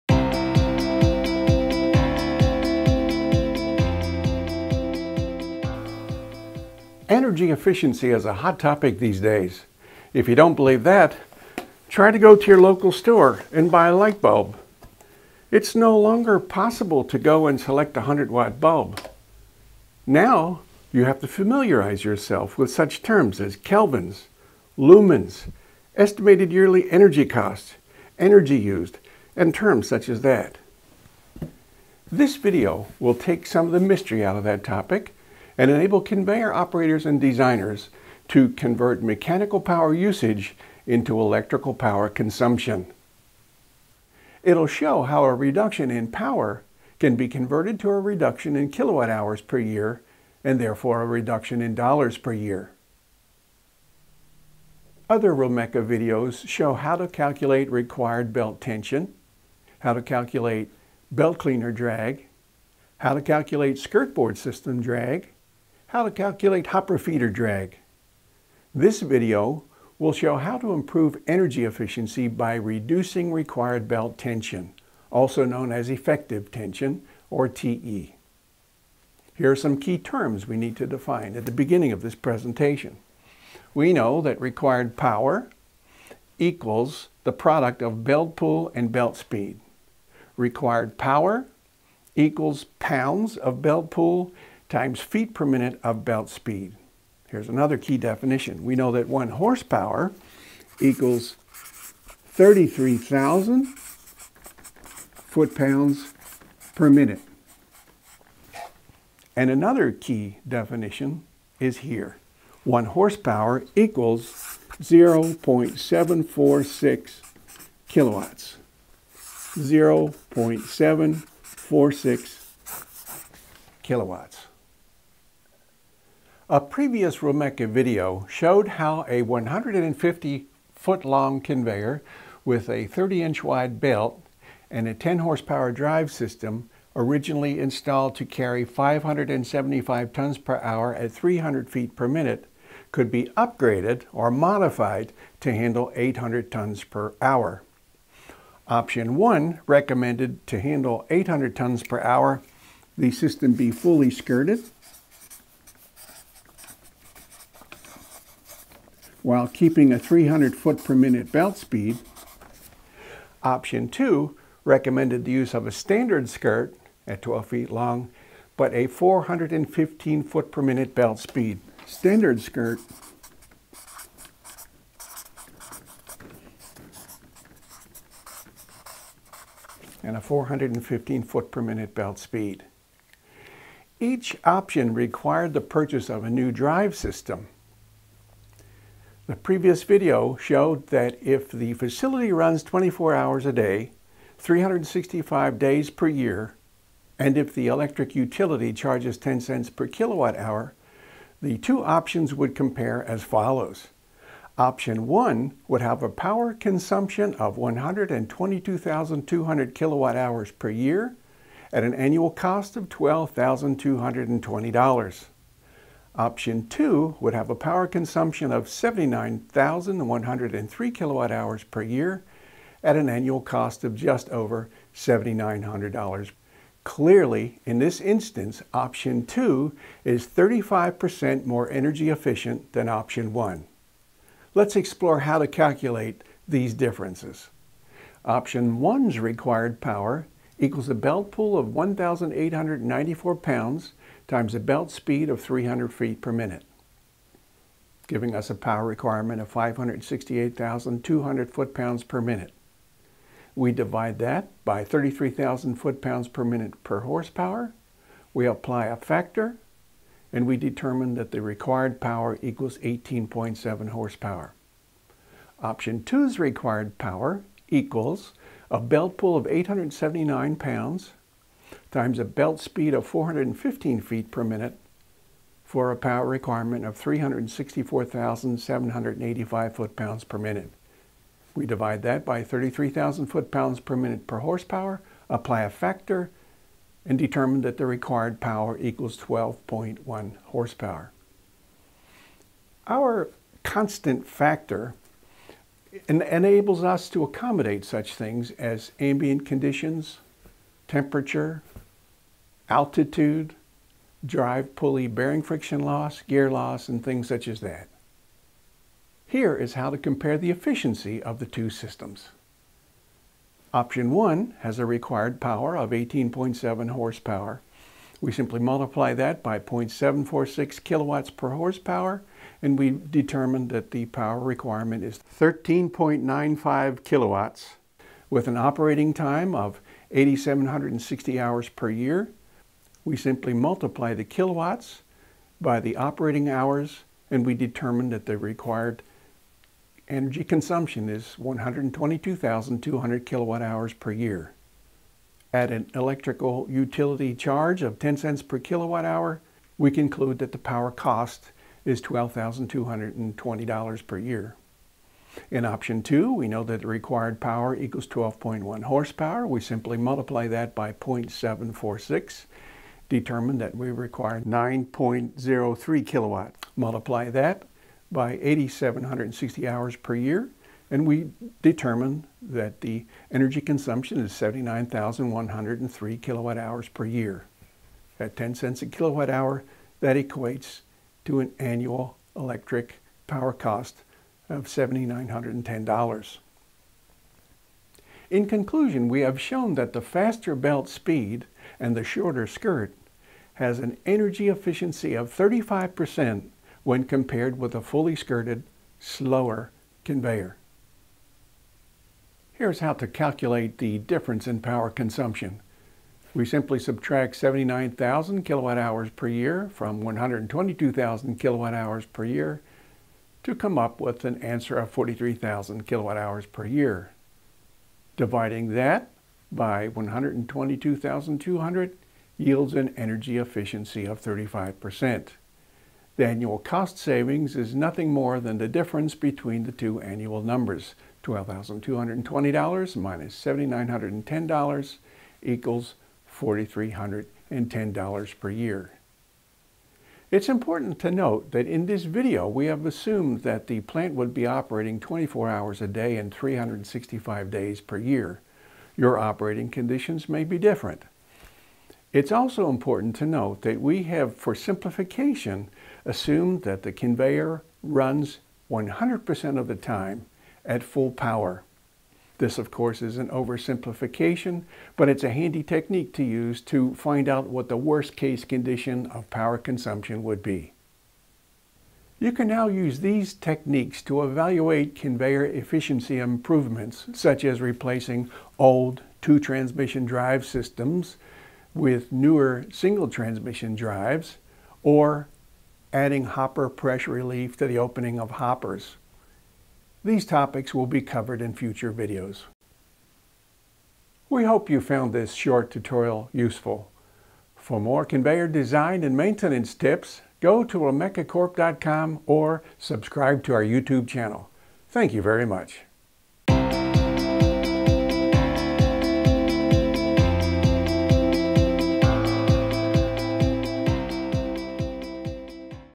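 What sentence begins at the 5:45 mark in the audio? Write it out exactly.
At an electrical utility charge of 10 cents per kilowatt hour, we conclude that the power cost is $12,220 per year.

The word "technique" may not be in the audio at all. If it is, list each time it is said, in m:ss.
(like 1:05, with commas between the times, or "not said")
7:45, 7:53.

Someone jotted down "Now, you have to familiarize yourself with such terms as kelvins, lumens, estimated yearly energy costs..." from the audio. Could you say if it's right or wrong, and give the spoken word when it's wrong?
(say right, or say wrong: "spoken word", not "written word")
right.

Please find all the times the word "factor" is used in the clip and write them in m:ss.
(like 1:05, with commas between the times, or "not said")
4:18, 4:45, 4:54.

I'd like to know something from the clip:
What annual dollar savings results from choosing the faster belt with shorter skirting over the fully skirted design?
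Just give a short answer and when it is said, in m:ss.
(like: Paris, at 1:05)
$4,310 per year, at 7:16.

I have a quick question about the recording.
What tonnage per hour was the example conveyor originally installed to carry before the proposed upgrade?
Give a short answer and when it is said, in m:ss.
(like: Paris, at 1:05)
575 tons per hour, at 2:18.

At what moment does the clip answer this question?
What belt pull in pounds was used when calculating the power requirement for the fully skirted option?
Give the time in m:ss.
4:01.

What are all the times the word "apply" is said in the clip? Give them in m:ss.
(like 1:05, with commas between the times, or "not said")
4:18, 4:45.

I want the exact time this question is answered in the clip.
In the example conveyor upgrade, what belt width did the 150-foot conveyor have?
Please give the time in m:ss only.
2:12.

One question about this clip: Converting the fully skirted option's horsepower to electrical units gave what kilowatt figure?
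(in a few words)
13.95 kilowatts.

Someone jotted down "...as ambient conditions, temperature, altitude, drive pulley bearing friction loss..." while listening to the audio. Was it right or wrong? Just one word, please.
right.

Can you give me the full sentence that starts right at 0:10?
If you don't believe that, try to go to your local store and buy a light bulb.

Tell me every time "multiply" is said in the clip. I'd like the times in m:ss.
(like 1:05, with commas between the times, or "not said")
5:18, 5:33, 5:59, 6:06.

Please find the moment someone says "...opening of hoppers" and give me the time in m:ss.
8:07.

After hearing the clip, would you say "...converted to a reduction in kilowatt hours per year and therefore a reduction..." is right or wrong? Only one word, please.
right.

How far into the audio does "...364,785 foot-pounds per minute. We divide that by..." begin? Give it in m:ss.
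4:36.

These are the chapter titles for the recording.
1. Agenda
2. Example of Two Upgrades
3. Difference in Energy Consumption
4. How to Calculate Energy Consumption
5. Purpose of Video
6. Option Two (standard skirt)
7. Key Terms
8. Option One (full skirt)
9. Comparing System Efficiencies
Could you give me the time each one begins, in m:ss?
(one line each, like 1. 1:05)
1. 0:32
2. 2:05
3. 3:03
4. 3:54
5. 1:08
6. 2:43
7. 1:19
8. 2:28
9. 5:08.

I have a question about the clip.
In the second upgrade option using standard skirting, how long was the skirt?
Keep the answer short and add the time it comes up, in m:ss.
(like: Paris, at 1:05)
12 feet, at 2:47.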